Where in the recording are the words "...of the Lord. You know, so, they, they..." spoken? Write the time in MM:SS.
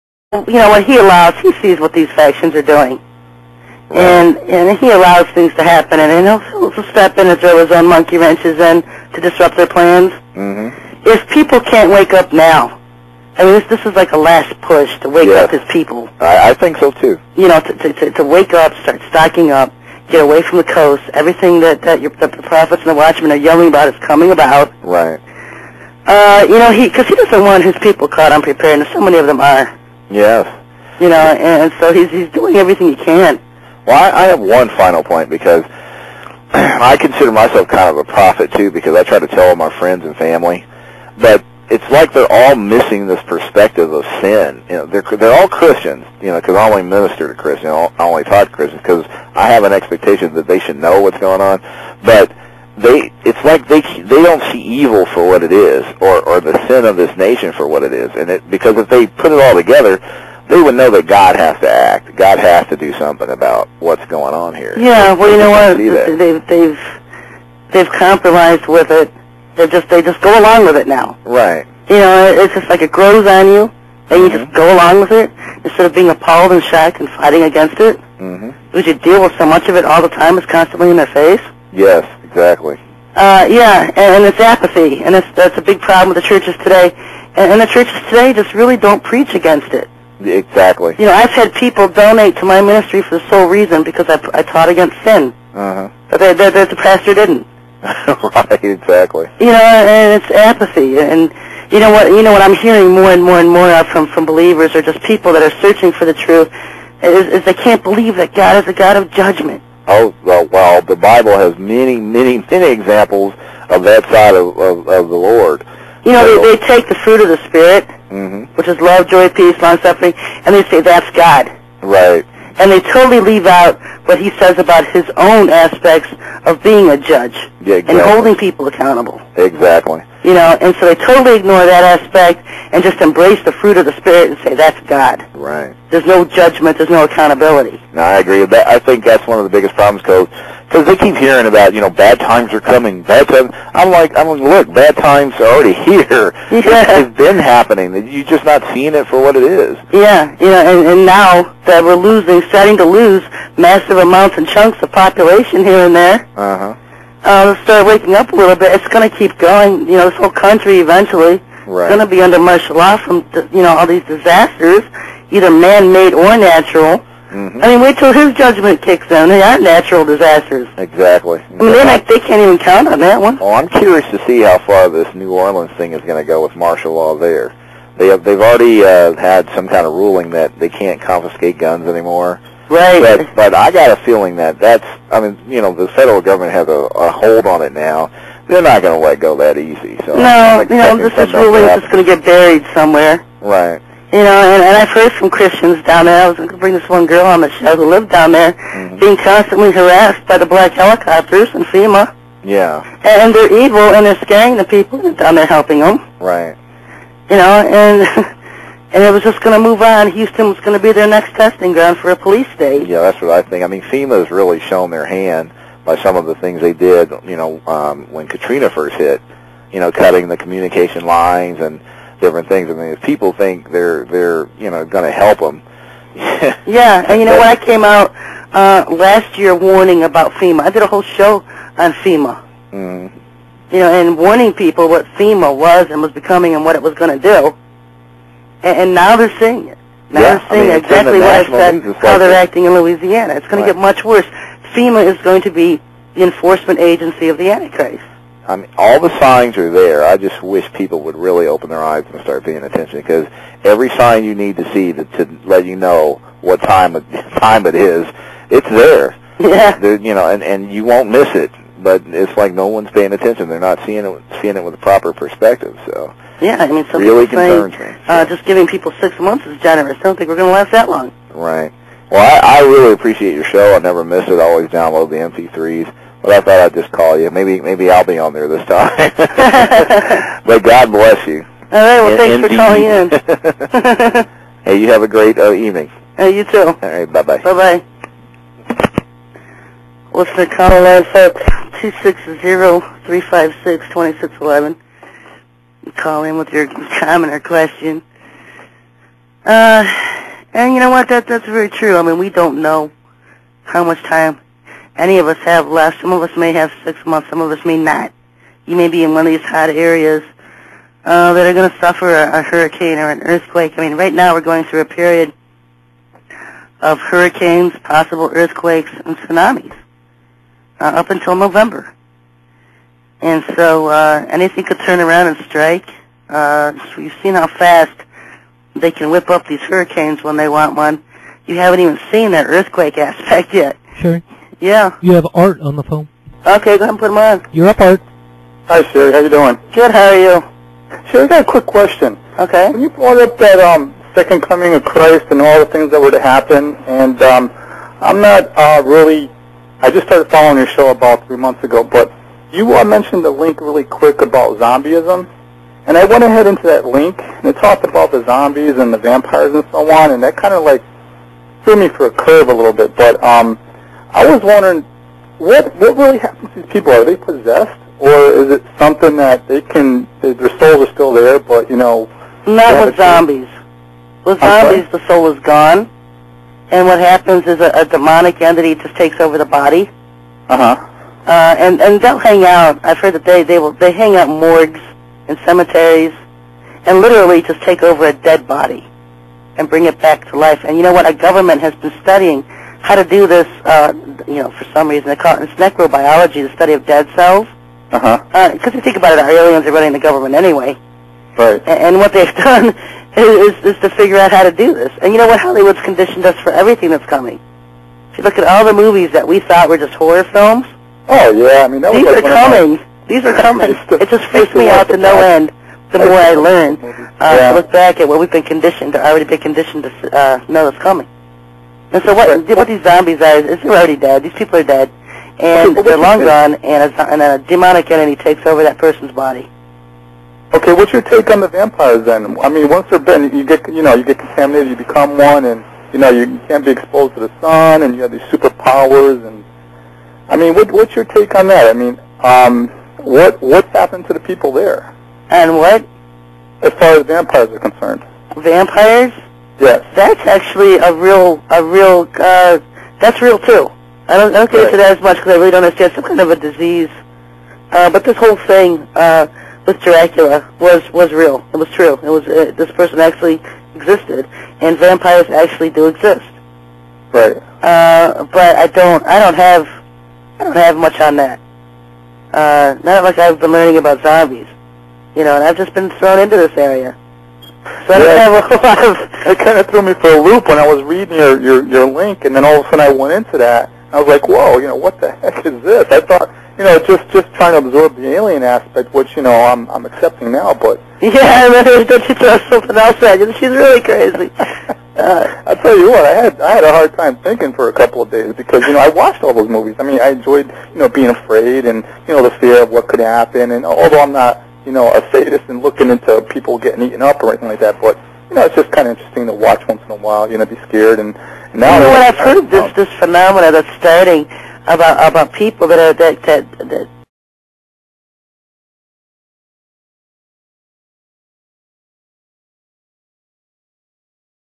01:54.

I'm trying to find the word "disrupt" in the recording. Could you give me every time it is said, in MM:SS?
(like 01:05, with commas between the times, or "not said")
00:09.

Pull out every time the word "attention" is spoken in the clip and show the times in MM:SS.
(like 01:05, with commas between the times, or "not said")
04:12, 04:23.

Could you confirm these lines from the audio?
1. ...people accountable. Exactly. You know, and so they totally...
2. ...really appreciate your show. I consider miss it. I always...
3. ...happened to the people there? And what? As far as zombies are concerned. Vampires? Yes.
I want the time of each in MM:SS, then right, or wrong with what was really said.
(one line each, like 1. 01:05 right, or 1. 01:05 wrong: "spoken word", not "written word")
1. 02:08 right
2. 04:32 wrong: "never", not "consider"
3. 07:23 wrong: "vampires", not "zombies".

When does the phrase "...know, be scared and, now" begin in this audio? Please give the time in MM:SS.
08:30.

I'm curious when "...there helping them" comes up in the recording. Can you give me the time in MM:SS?
03:25.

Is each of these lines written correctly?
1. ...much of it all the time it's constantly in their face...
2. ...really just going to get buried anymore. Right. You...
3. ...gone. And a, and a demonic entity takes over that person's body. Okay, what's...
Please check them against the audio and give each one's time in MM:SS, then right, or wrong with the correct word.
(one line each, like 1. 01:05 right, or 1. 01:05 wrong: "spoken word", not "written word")
1. 01:19 right
2. 03:11 wrong: "somewhere", not "anymore"
3. 07:06 right.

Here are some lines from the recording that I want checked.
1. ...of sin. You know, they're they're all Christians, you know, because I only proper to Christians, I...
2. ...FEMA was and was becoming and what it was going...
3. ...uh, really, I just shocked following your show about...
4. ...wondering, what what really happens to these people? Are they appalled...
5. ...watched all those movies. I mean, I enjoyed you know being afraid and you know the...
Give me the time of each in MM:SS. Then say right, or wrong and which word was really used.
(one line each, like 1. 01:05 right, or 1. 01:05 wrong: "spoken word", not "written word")
1. 00:43 wrong: "minister", not "proper"
2. 03:55 right
3. 05:48 wrong: "started", not "shocked"
4. 06:04 wrong: "possessed", not "appalled"
5. 08:18 right.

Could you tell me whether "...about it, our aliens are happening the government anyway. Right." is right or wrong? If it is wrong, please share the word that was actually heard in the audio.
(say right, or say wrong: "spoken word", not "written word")
wrong: "running", not "happening".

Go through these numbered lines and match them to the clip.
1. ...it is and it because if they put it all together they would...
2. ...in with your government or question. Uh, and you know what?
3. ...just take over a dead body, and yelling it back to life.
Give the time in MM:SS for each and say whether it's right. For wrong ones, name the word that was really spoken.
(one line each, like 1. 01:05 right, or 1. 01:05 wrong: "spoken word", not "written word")
1. 00:57 right
2. 04:56 wrong: "comment", not "government"
3. 06:27 wrong: "bring", not "yelling".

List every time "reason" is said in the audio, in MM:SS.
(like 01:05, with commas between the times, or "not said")
01:33, 06:34.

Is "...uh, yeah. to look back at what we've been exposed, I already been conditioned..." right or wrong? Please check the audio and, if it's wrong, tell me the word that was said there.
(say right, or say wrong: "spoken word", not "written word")
wrong: "conditioned", not "exposed".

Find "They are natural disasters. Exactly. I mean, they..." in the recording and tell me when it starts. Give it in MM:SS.
02:49.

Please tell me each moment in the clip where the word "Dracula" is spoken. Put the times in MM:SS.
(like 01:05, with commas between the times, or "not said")
07:39.